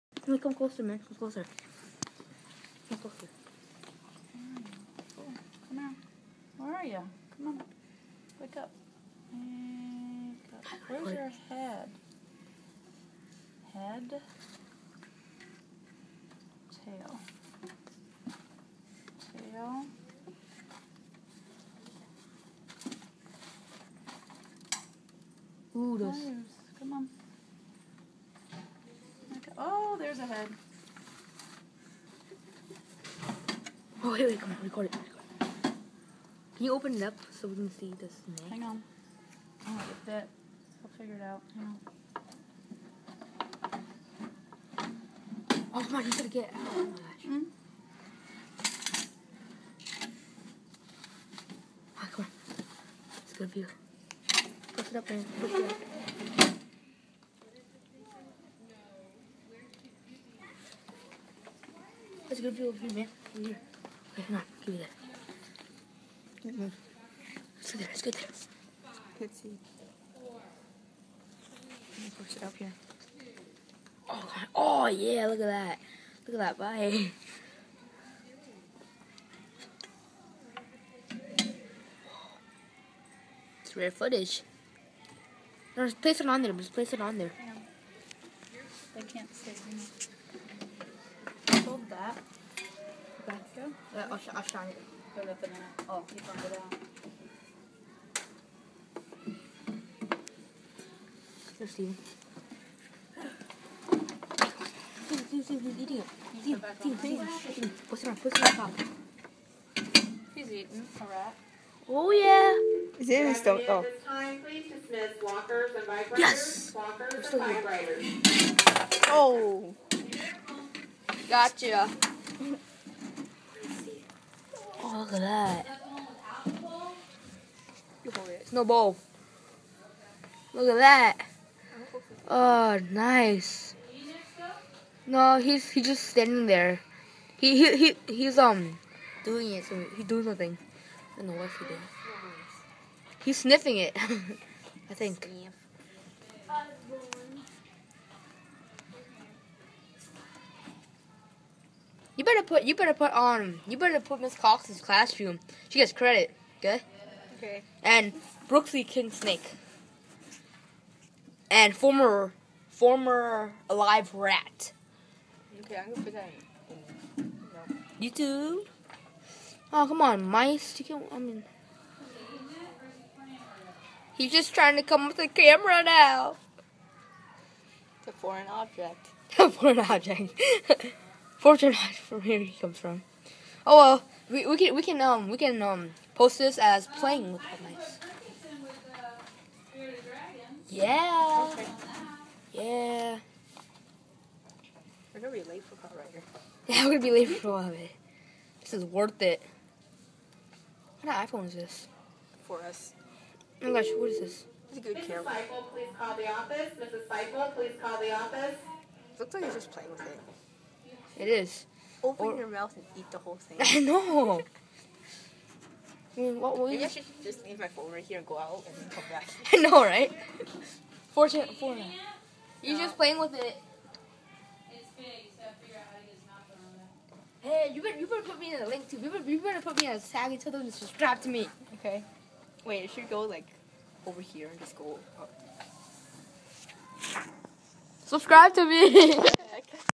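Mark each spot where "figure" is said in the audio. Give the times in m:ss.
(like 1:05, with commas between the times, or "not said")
0:40.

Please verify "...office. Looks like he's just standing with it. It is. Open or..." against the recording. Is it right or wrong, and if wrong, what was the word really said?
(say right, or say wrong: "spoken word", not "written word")
wrong: "playing", not "standing".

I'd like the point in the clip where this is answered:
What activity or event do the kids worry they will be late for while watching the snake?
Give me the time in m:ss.
3:15.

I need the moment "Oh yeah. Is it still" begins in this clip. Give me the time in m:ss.
1:51.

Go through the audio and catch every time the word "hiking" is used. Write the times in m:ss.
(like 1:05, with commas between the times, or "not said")
not said.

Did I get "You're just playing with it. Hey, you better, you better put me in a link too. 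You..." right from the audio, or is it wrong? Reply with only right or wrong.
right.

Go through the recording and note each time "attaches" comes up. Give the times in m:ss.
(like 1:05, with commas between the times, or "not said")
not said.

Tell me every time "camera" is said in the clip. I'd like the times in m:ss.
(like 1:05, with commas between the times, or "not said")
2:55, 3:25.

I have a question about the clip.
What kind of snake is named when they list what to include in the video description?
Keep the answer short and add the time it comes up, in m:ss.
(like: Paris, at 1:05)
King Snake, at 2:38.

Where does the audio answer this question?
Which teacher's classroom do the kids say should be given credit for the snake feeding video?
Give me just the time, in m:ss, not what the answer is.
2:34.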